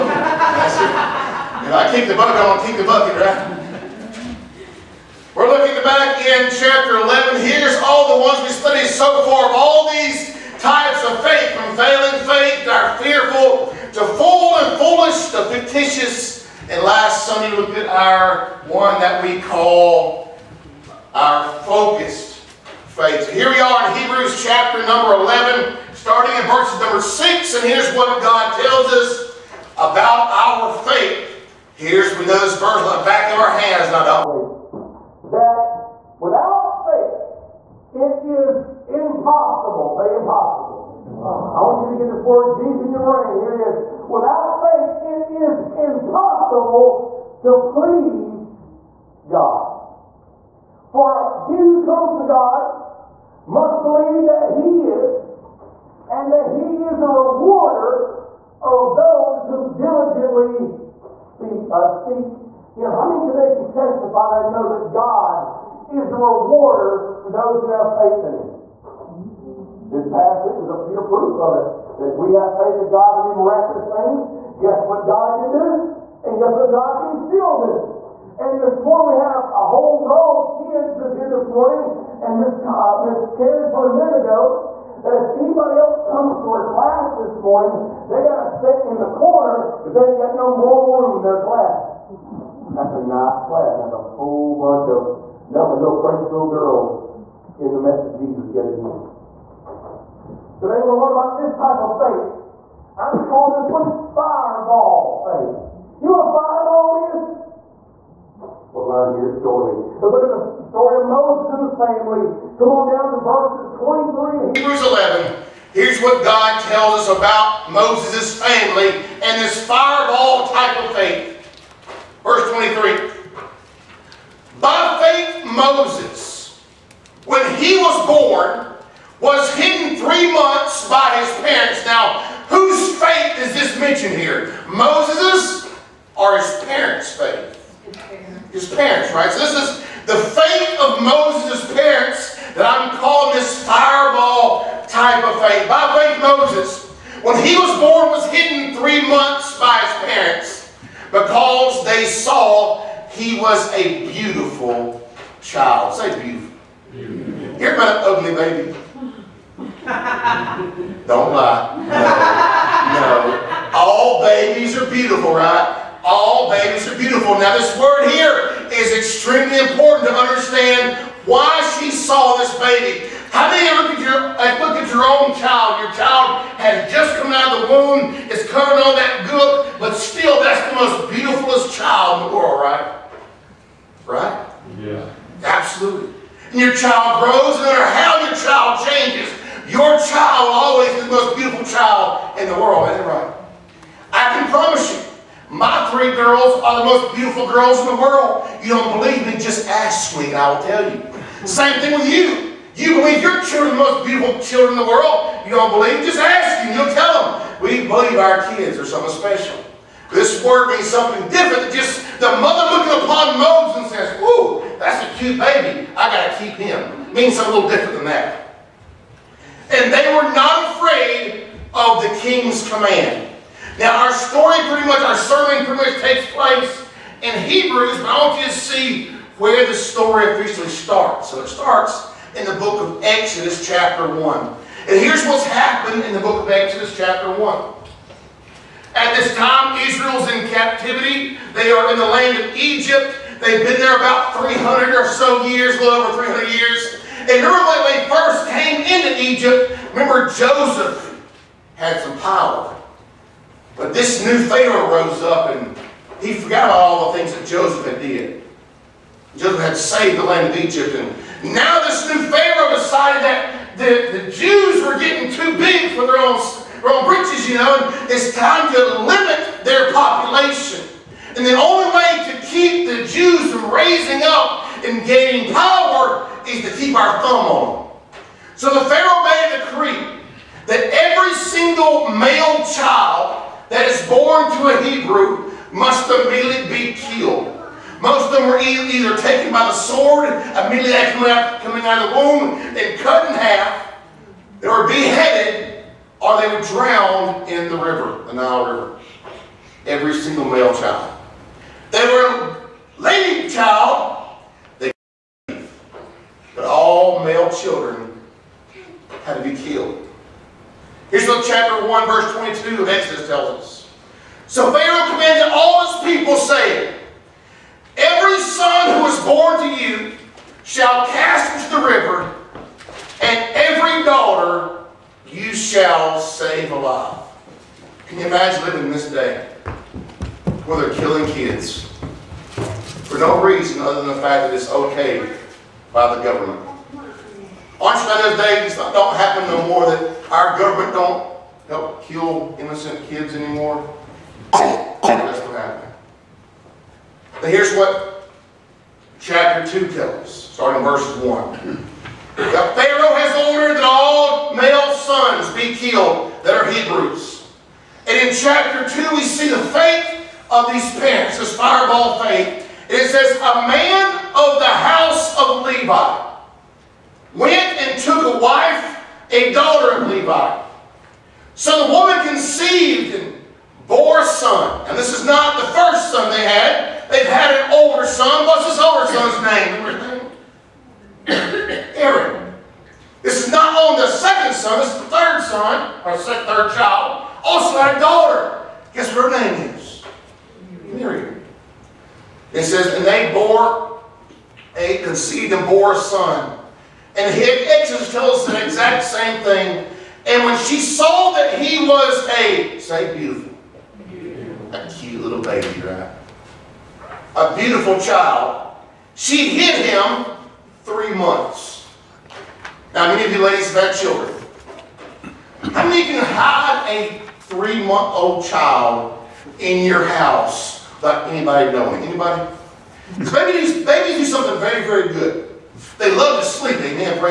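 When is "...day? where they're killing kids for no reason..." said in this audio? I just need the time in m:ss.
5:29.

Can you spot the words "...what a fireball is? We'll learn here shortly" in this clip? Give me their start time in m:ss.
1:46.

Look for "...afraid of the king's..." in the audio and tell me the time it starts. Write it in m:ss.
3:40.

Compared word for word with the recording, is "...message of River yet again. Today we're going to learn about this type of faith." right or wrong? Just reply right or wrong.
wrong.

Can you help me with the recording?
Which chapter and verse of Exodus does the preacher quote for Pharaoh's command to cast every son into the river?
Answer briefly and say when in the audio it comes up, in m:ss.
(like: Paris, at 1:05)
Chapter 1, verse 22, at 5:11.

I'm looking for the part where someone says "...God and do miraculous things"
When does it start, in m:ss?
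1:12.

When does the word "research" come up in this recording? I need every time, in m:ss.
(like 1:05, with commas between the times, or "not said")
not said.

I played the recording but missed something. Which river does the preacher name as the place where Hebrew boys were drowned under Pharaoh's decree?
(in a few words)
Nile River.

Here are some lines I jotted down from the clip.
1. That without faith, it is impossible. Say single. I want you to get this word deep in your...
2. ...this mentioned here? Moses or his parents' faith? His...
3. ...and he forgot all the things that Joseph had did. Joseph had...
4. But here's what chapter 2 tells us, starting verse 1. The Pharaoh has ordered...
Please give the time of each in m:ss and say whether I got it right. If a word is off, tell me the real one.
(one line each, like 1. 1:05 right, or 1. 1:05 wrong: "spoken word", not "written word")
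1. 0:35 wrong: "impossible", not "single"
2. 2:13 right
3. 4:15 right
4. 5:47 right.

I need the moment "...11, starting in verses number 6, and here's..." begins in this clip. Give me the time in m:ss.
0:25.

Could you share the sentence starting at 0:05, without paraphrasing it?
We're looking back in chapter 11.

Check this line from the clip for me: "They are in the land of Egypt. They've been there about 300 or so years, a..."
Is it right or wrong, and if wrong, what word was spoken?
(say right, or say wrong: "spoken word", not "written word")
right.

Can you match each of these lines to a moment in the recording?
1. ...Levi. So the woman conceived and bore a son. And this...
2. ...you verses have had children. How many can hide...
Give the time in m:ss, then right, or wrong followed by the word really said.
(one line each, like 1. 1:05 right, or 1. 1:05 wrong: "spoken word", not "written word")
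1. 6:10 right
2. 6:53 wrong: "ladies", not "verses".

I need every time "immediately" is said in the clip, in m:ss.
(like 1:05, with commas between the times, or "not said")
4:46, 4:50.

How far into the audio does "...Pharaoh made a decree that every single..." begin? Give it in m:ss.
4:38.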